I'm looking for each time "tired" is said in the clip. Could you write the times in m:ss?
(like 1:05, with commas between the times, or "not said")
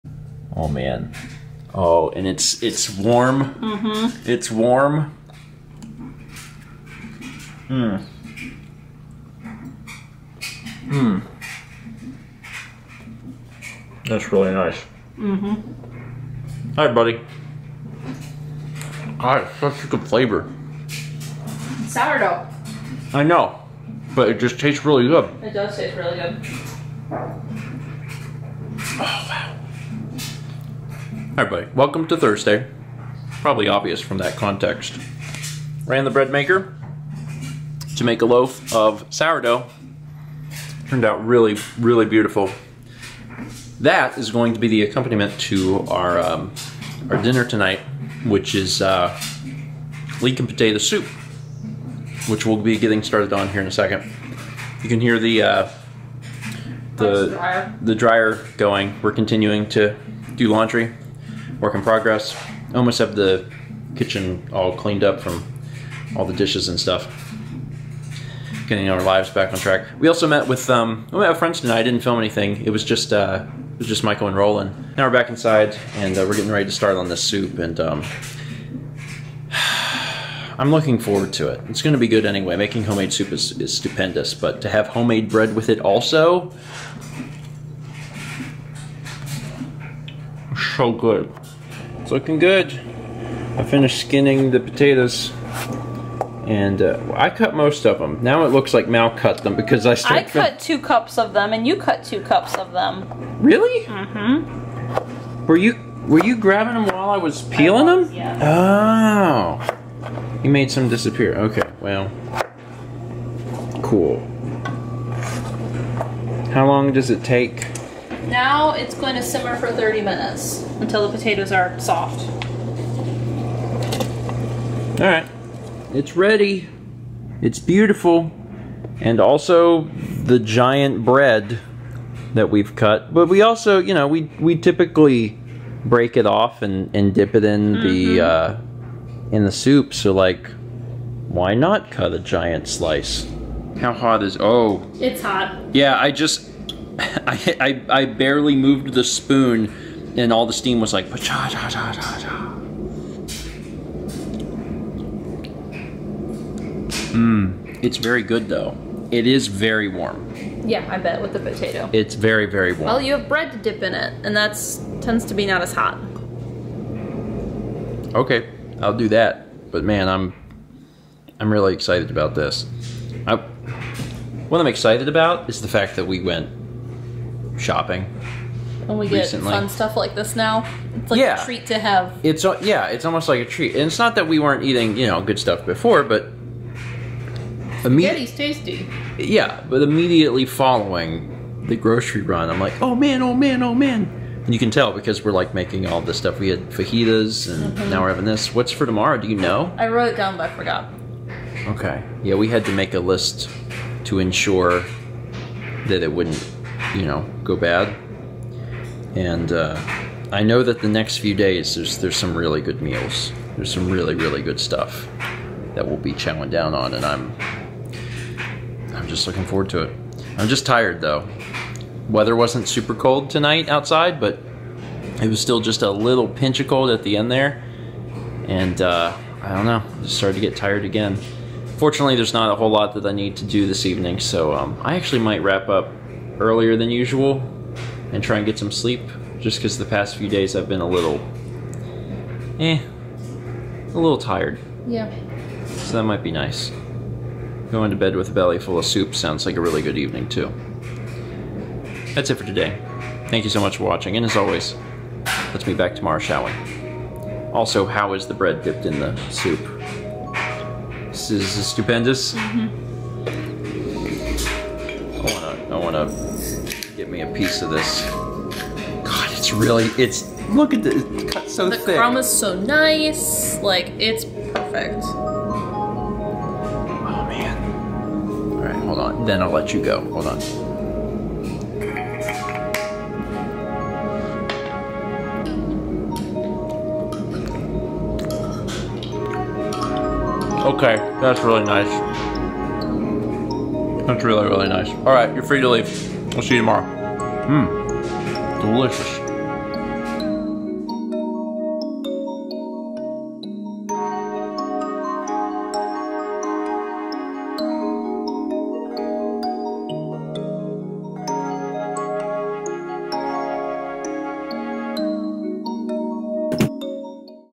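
3:40, 3:50, 4:04.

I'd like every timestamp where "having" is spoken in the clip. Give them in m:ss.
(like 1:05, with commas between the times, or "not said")
3:18.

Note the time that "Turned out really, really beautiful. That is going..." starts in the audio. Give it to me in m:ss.
0:40.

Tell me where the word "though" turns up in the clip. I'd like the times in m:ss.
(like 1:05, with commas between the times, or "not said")
2:38, 3:41.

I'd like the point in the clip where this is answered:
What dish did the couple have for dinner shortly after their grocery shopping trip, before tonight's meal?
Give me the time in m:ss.
3:16.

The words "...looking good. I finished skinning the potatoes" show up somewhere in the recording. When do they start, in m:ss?
1:32.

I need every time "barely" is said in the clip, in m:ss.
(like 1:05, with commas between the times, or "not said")
2:28.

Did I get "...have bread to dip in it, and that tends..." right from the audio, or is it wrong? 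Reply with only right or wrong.
right.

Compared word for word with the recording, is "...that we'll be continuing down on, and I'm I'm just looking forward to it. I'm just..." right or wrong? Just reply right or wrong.
wrong.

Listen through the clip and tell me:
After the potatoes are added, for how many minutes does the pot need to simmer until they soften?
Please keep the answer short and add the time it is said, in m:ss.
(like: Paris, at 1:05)
30, at 1:59.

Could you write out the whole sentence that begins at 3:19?
I wrote it down, but I forgot.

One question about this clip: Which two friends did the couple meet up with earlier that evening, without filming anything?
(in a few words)
Michael and Roland.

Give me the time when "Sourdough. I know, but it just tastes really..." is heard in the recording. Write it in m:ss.
0:21.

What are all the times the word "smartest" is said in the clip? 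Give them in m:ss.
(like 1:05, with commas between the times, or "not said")
not said.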